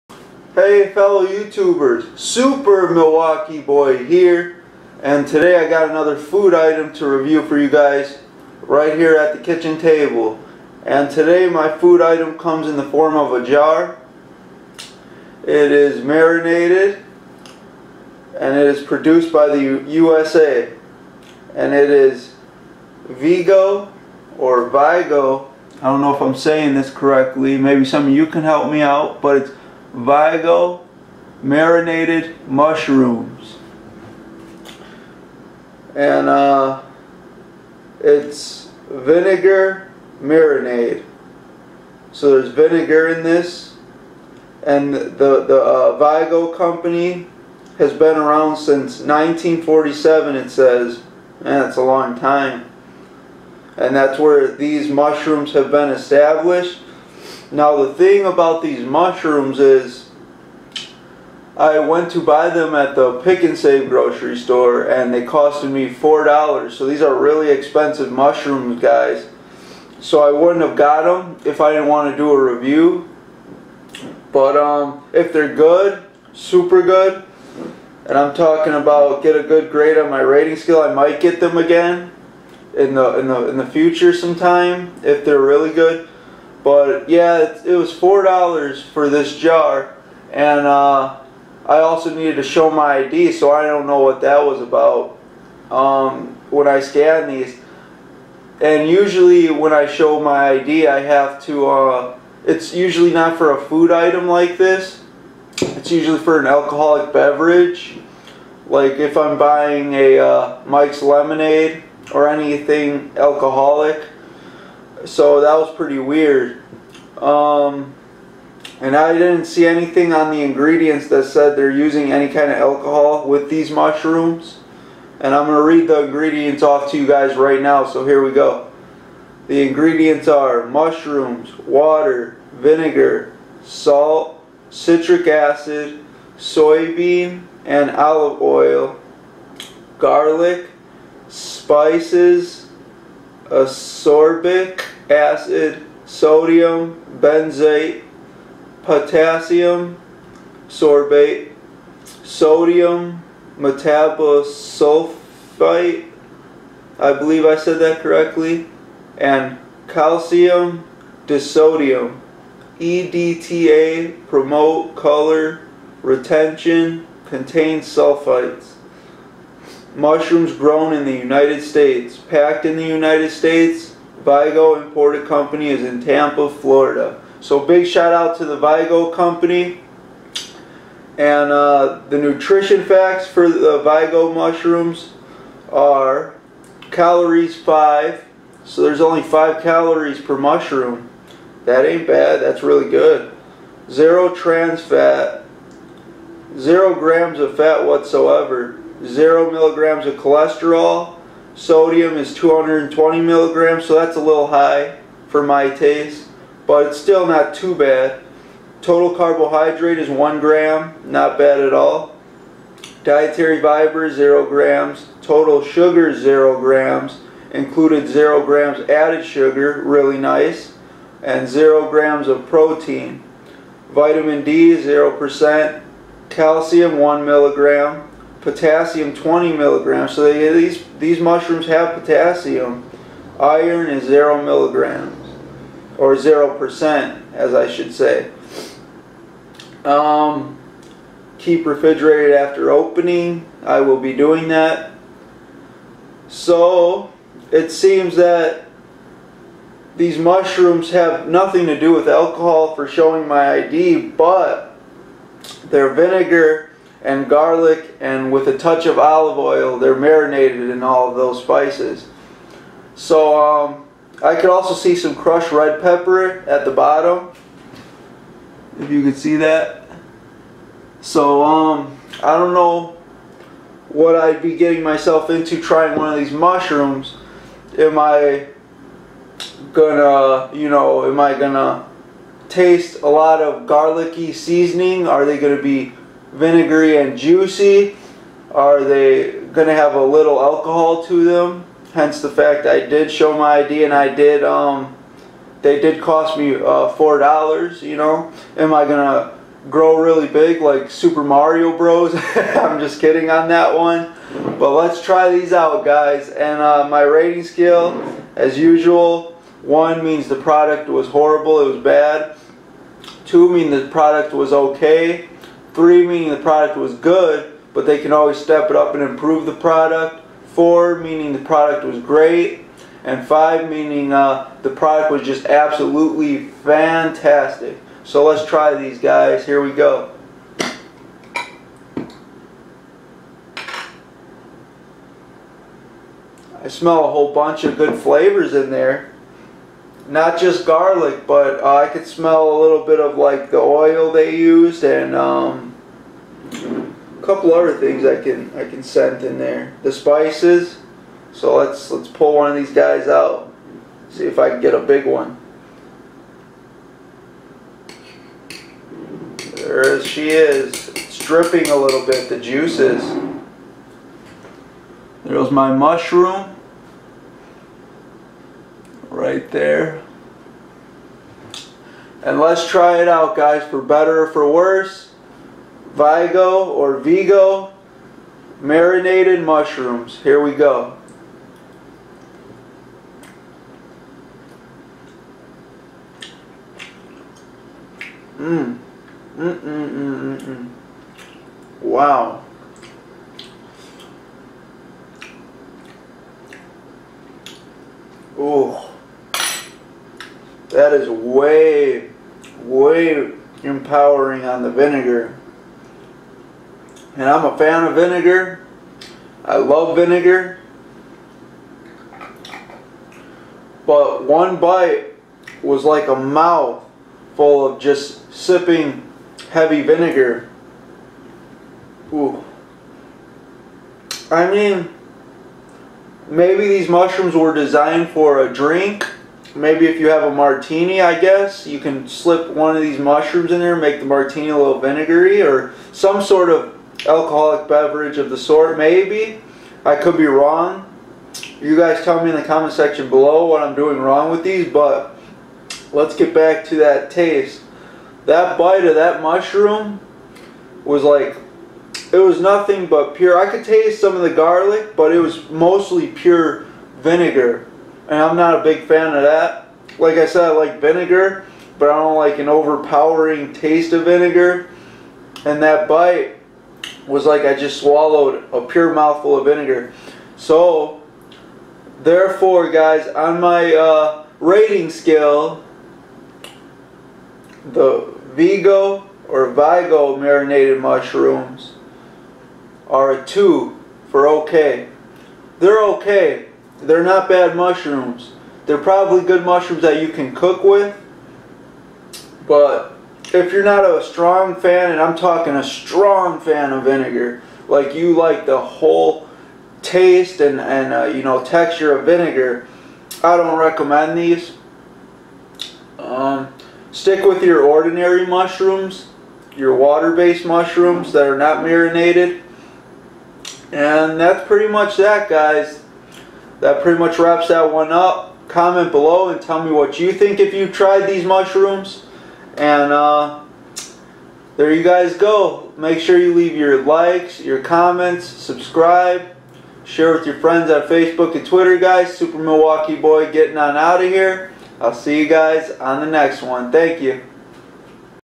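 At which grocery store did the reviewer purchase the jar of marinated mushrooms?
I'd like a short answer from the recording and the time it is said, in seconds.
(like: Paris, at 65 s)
Pick and Save, at 63 s.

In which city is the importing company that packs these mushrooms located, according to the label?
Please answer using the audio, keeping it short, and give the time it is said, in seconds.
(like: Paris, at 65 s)
Tampa, Florida, at 176 s.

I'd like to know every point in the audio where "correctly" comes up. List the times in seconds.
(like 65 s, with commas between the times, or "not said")
26 s, 158 s.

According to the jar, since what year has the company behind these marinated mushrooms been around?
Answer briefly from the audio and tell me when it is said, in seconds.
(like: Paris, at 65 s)
1947, at 48 s.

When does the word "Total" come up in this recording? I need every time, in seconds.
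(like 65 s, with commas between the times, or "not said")
208 s, 215 s.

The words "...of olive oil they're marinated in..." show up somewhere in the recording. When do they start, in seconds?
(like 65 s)
258 s.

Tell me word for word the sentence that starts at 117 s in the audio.
Um, and I didn't see anything on the ingredients that said they're using any kind of alcohol with these mushrooms.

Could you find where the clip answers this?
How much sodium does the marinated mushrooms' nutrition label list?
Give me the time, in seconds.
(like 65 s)
202 s.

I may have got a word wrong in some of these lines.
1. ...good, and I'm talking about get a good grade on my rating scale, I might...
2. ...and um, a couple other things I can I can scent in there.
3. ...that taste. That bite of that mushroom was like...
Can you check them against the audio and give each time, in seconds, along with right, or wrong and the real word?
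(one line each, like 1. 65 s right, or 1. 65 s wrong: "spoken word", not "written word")
1. 76 s right
2. 344 s right
3. 446 s right.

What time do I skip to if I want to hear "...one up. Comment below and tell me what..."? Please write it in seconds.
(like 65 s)
517 s.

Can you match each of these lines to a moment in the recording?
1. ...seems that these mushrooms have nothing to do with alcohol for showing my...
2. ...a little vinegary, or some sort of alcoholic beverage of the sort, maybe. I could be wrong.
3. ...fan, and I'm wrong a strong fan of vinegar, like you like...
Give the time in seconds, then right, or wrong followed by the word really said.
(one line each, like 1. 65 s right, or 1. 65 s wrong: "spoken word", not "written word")
1. 247 s right
2. 434 s right
3. 494 s wrong: "talking", not "wrong".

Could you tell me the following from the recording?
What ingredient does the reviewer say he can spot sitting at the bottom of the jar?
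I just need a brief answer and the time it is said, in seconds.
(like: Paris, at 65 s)
crushed red pepper, at 265 s.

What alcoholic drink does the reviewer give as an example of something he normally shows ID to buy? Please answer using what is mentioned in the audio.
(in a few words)
Mike's Lemonade.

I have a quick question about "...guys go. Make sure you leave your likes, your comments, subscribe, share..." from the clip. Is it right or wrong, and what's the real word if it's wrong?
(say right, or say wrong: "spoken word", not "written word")
right.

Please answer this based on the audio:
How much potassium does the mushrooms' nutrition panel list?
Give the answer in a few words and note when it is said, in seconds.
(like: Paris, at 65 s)
20 milligrams, at 228 s.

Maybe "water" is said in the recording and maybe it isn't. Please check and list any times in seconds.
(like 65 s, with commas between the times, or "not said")
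131 s, 509 s.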